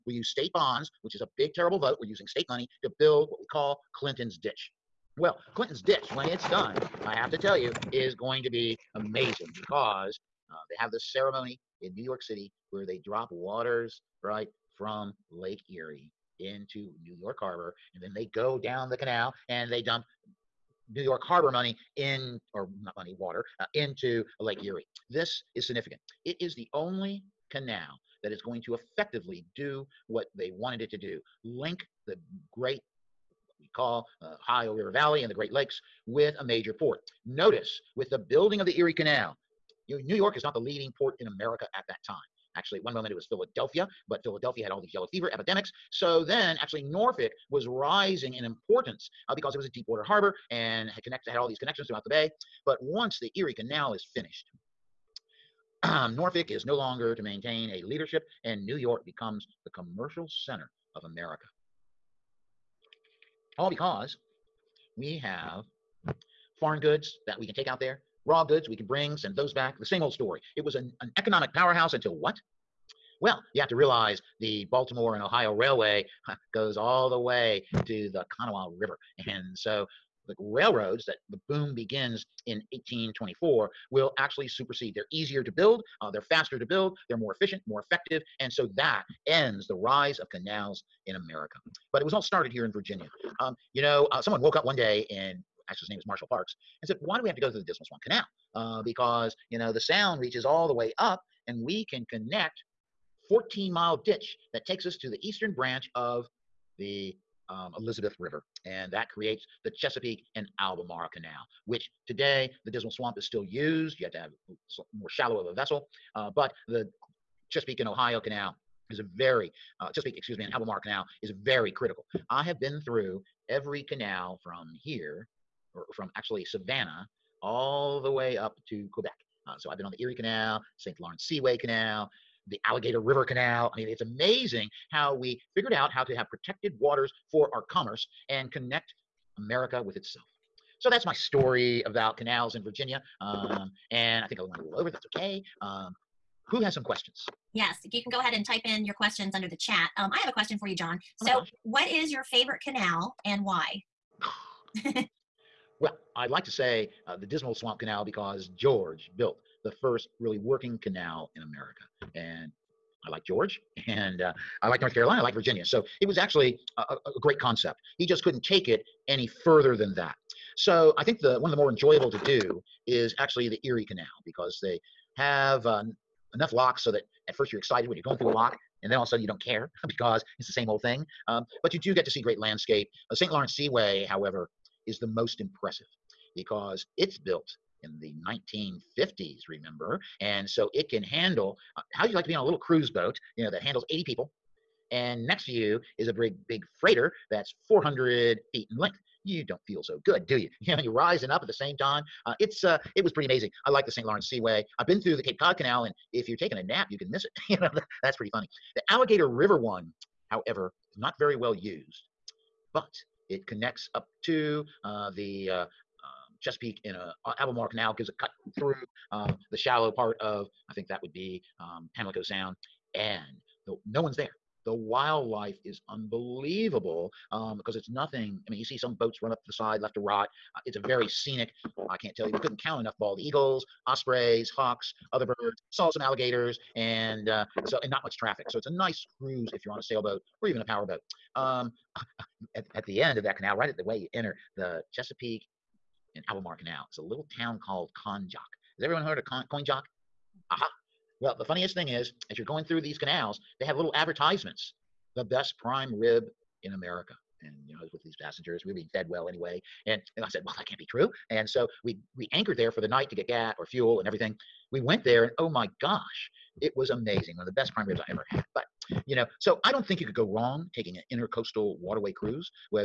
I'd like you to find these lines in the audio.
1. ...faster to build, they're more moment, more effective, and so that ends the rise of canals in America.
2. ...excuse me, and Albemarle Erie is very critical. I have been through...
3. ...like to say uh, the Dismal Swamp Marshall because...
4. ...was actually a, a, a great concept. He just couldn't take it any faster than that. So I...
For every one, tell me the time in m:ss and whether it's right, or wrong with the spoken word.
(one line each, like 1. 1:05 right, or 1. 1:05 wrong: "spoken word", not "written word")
1. 1:26 wrong: "efficient", not "moment"
2. 2:00 wrong: "Canal", not "Erie"
3. 2:36 wrong: "Canal", not "Marshall"
4. 2:46 wrong: "further", not "faster".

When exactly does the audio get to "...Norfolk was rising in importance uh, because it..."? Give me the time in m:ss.
0:46.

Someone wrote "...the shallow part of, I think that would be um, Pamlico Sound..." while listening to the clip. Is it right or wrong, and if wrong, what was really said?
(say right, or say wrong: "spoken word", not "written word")
right.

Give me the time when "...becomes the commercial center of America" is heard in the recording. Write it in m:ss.
0:59.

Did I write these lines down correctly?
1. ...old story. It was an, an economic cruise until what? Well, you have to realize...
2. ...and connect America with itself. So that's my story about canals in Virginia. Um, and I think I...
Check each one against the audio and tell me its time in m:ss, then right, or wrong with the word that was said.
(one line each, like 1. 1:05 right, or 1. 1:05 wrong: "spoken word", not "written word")
1. 1:10 wrong: "powerhouse", not "cruise"
2. 2:18 right.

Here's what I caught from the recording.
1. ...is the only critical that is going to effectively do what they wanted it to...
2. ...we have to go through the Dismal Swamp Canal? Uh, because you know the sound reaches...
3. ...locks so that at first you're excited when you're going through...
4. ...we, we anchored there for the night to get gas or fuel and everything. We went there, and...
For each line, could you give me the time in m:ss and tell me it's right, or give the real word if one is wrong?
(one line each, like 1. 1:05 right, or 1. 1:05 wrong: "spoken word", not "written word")
1. 0:26 wrong: "canal", not "critical"
2. 1:37 right
3. 2:56 right
4. 4:21 right.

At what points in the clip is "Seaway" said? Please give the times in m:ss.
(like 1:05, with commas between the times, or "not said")
2:11, 3:03, 3:24.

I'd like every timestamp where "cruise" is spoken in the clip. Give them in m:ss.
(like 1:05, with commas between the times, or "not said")
3:12, 3:59, 4:32.